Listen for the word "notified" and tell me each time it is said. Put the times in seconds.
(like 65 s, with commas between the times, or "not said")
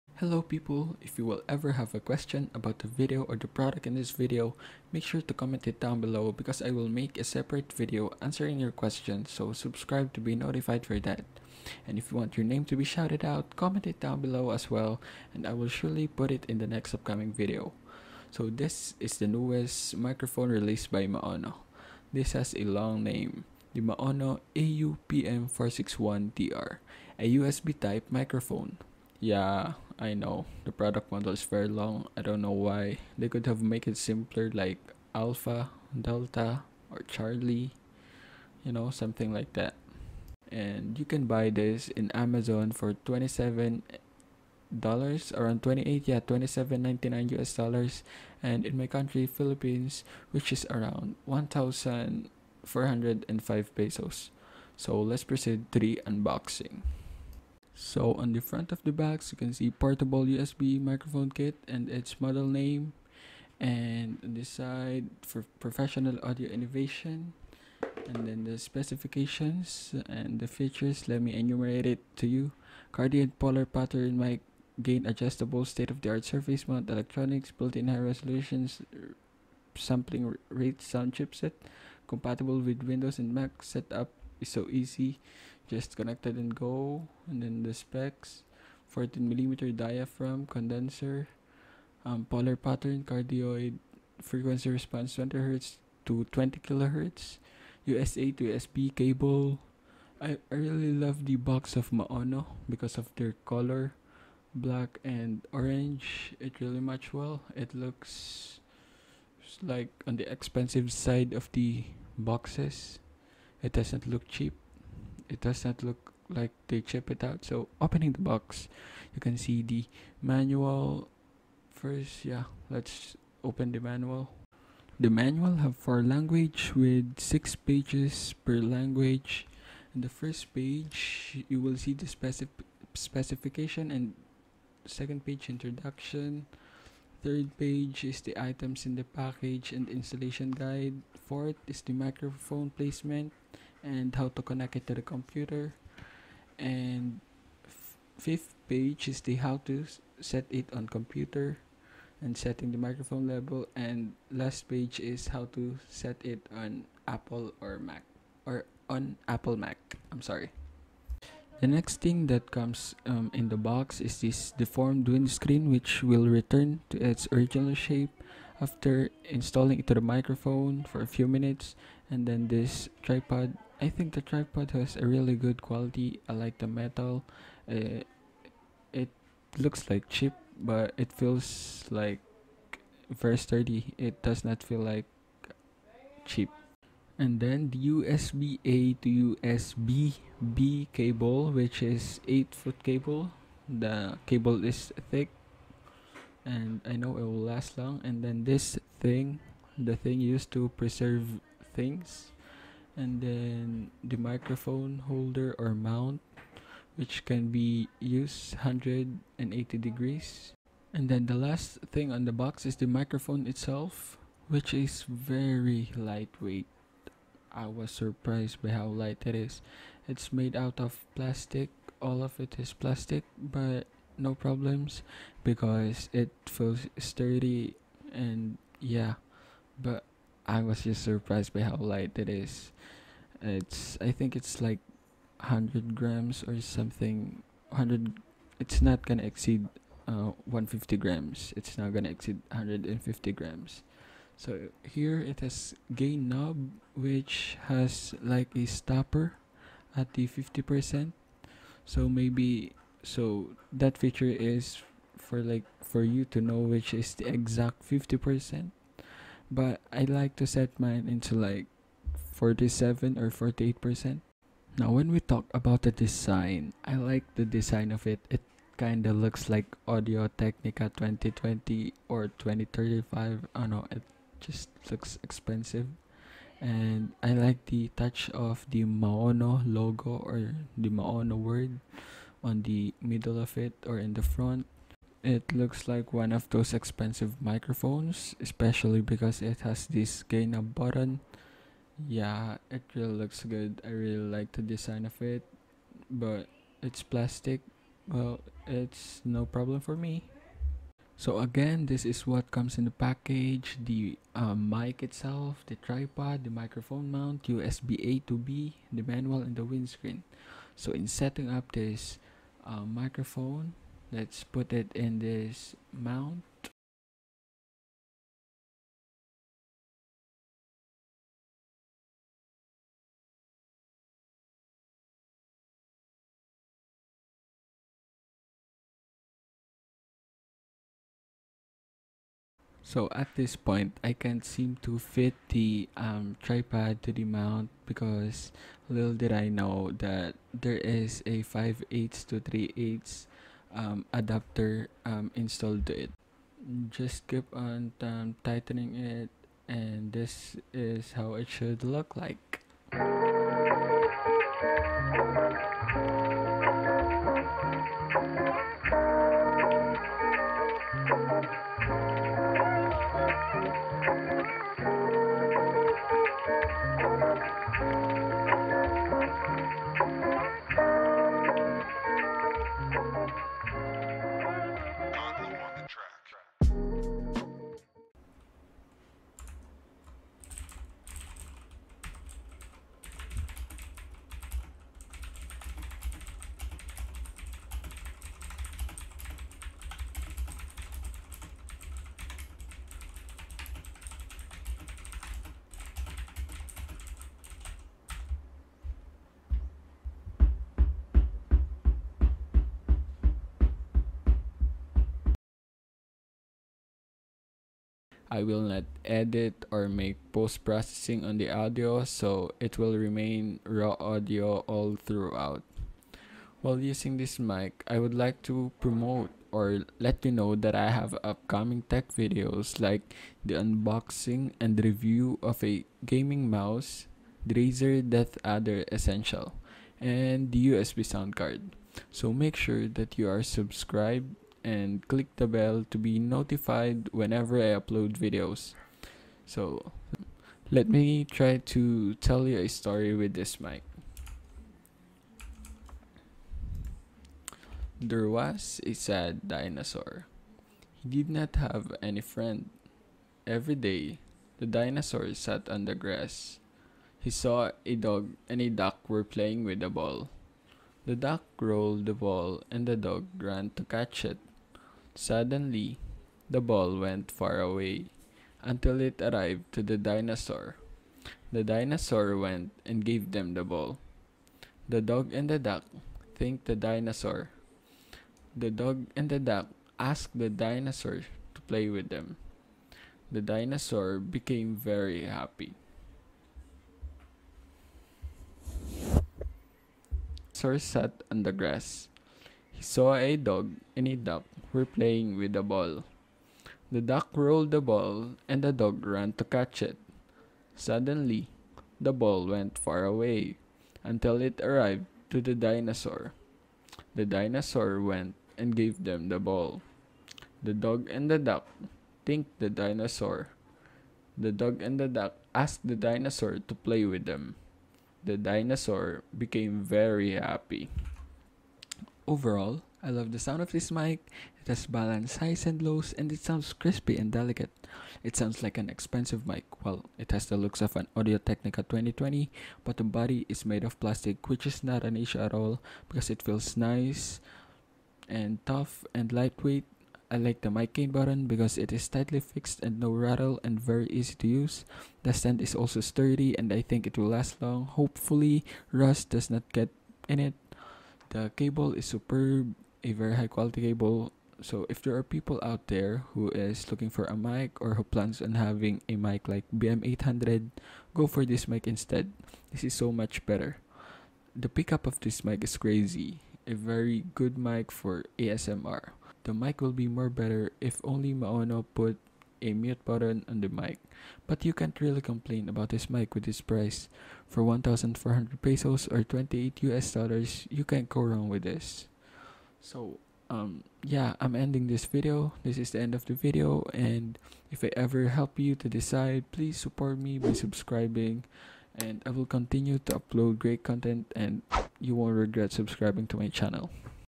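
10 s, 436 s.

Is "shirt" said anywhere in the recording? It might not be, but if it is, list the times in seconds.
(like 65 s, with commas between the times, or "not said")
not said.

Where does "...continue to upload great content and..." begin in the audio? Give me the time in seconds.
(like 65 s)
592 s.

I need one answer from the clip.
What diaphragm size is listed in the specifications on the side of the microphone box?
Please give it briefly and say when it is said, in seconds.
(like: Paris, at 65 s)
14 millimeter, at 88 s.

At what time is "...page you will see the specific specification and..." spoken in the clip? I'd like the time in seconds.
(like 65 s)
130 s.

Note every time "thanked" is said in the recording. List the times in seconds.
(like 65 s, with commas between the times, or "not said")
476 s, 512 s.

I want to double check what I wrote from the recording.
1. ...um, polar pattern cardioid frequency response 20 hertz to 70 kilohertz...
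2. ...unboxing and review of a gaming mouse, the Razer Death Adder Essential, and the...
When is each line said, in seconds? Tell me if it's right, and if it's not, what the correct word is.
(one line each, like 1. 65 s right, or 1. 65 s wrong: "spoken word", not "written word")
1. 92 s wrong: "20", not "70"
2. 423 s right.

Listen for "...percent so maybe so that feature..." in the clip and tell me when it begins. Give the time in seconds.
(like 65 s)
250 s.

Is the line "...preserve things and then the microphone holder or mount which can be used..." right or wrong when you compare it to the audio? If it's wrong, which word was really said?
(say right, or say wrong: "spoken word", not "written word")
right.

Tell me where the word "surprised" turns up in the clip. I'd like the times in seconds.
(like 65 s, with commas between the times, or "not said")
217 s, 231 s.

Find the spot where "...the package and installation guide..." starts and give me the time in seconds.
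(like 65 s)
138 s.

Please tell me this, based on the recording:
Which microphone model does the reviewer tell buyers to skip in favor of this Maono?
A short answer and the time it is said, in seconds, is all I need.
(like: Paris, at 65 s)
BM800, at 559 s.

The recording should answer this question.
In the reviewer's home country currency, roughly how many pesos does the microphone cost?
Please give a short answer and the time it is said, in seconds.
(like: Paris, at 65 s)
1,405 pesos, at 51 s.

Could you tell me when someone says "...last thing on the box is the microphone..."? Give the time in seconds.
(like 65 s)
211 s.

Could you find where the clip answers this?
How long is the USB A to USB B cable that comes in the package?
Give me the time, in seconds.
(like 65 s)
192 s.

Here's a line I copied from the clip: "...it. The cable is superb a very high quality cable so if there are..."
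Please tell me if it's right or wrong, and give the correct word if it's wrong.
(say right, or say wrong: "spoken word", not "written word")
right.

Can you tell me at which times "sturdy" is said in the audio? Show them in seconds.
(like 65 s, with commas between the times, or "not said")
183 s, 226 s, 546 s.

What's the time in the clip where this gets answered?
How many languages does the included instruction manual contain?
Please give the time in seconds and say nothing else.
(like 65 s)
125 s.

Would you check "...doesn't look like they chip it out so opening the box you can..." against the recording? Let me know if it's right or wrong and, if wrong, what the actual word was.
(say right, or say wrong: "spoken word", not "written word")
right.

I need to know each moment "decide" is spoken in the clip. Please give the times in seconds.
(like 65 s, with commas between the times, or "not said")
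588 s.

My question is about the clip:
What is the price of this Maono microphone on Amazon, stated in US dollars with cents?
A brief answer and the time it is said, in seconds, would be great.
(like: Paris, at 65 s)
$27.99, at 46 s.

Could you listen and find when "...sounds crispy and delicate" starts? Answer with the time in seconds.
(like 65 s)
526 s.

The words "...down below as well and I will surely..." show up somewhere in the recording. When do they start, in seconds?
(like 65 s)
13 s.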